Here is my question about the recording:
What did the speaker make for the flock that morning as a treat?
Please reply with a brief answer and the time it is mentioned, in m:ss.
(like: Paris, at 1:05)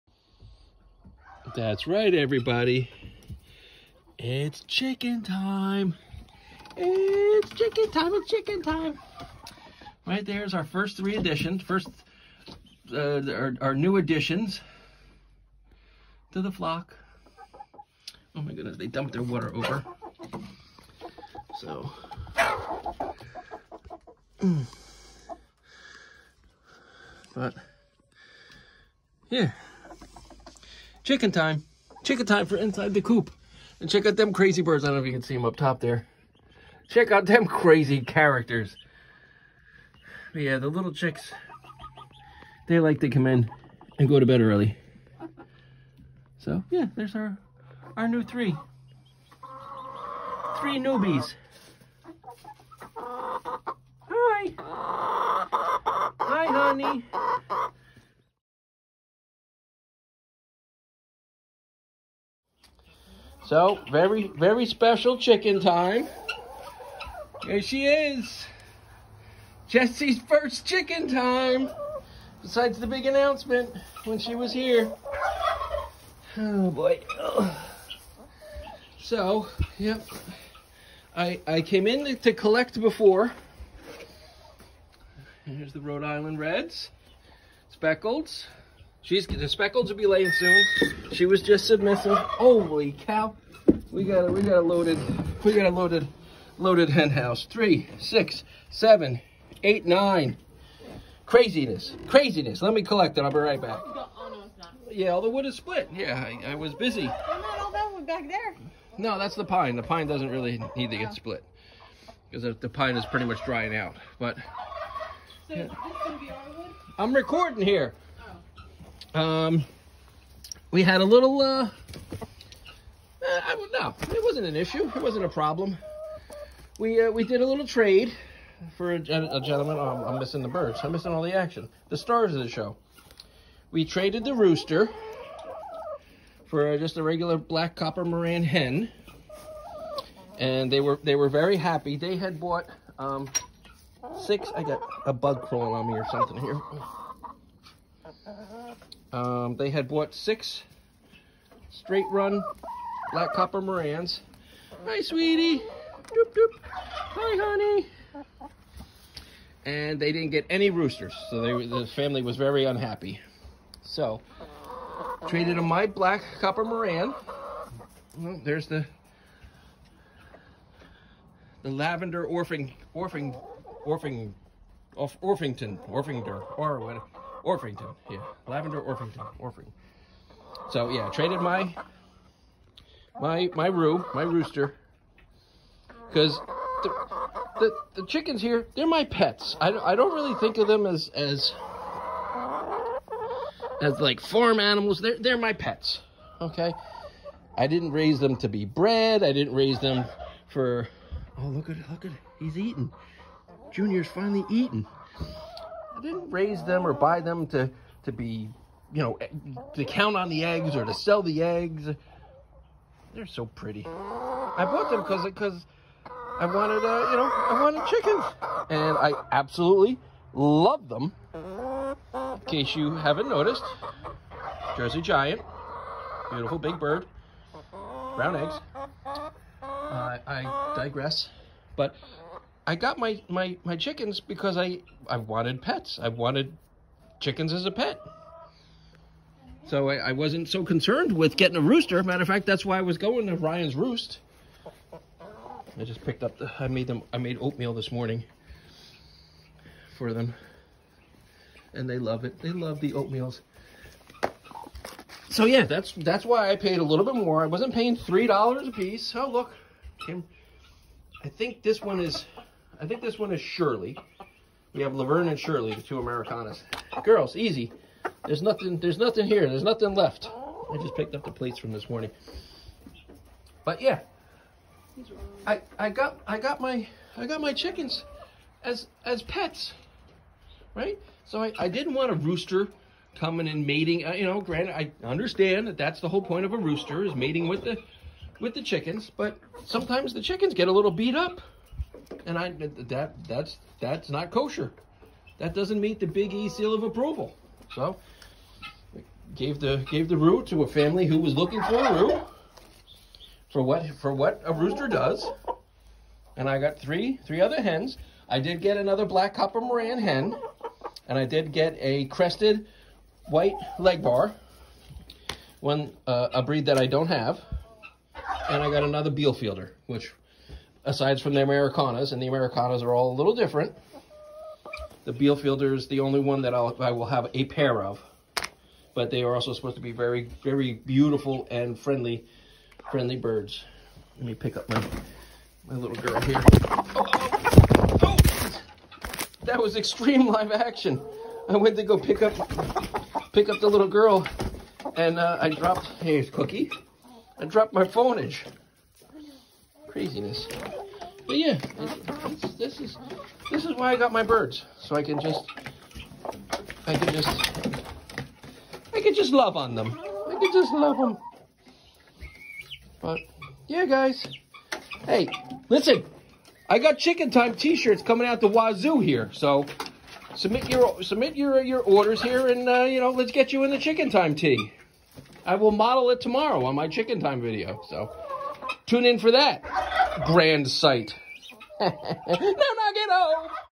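Oatmeal, at 4:07.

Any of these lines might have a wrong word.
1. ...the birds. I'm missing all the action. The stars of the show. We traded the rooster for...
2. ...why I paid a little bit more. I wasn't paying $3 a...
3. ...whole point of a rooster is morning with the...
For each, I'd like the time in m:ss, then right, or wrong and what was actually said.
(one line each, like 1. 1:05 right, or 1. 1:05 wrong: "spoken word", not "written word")
1. 2:10 right
2. 4:16 right
3. 4:46 wrong: "mating", not "morning".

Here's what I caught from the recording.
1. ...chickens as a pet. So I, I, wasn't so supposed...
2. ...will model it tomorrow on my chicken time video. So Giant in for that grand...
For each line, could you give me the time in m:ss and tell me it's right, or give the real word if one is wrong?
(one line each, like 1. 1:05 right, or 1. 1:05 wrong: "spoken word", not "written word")
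1. 3:57 wrong: "concerned", not "supposed"
2. 6:15 wrong: "Tune", not "Giant".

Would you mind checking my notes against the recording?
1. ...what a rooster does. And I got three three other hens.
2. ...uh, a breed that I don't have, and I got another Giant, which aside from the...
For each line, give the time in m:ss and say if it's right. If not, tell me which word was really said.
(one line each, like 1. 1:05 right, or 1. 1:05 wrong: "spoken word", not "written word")
1. 5:04 right
2. 5:16 wrong: "Bielefelder", not "Giant".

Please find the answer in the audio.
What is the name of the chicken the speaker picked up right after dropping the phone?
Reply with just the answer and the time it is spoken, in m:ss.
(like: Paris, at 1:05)
Cookie, at 5:46.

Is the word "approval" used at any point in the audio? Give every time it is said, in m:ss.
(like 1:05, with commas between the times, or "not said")
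4:56.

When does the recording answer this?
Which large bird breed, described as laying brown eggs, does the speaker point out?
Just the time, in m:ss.
3:44.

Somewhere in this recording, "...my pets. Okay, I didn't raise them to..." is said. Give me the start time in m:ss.
3:15.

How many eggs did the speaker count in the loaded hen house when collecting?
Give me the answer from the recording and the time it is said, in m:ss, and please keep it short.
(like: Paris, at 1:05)
9, at 1:39.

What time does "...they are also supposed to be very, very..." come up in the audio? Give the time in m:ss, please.
5:29.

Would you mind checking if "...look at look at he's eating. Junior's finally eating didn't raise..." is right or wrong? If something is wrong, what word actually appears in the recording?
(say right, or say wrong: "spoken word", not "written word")
right.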